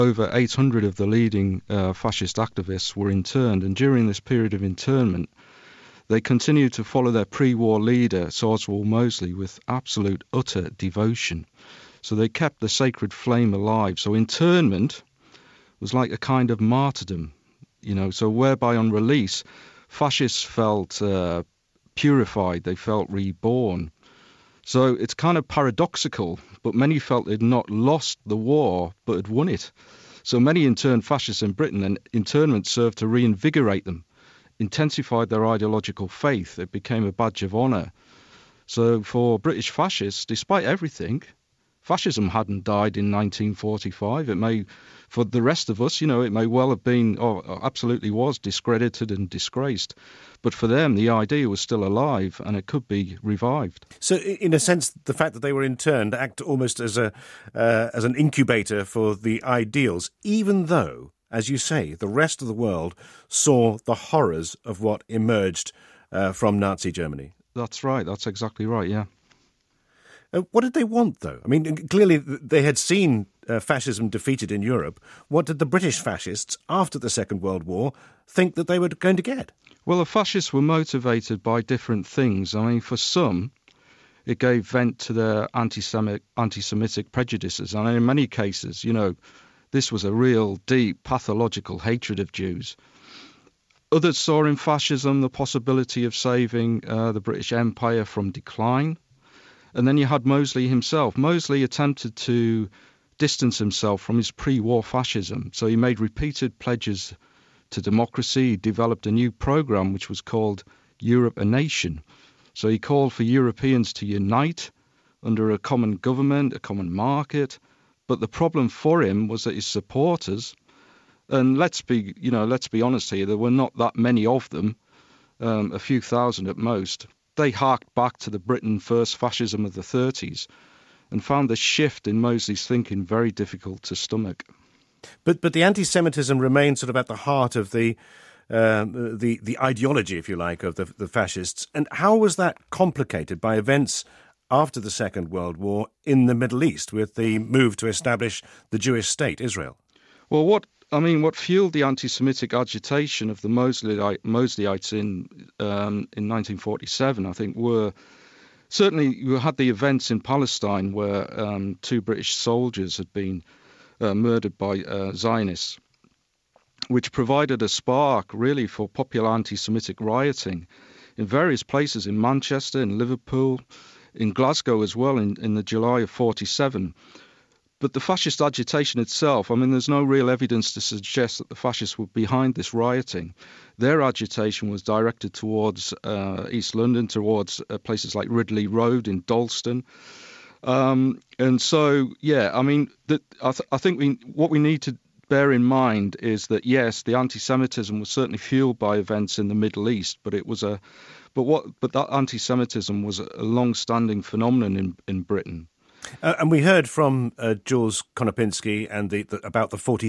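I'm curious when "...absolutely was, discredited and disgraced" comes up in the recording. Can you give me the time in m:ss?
0:47.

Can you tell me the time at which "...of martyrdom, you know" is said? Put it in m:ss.
0:16.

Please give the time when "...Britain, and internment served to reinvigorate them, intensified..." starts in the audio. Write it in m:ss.
0:31.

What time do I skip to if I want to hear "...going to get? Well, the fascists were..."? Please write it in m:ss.
1:18.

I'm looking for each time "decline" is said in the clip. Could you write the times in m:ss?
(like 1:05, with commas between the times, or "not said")
1:38.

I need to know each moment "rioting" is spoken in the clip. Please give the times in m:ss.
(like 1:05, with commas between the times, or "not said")
2:49, 3:02.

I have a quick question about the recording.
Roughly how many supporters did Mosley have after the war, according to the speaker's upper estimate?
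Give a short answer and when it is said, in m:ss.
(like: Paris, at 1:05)
A few thousand, at 2:05.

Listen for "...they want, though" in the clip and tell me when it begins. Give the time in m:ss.
1:10.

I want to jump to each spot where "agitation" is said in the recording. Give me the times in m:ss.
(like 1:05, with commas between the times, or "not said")
2:32, 2:58, 3:04.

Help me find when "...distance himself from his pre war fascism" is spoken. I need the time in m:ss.
1:43.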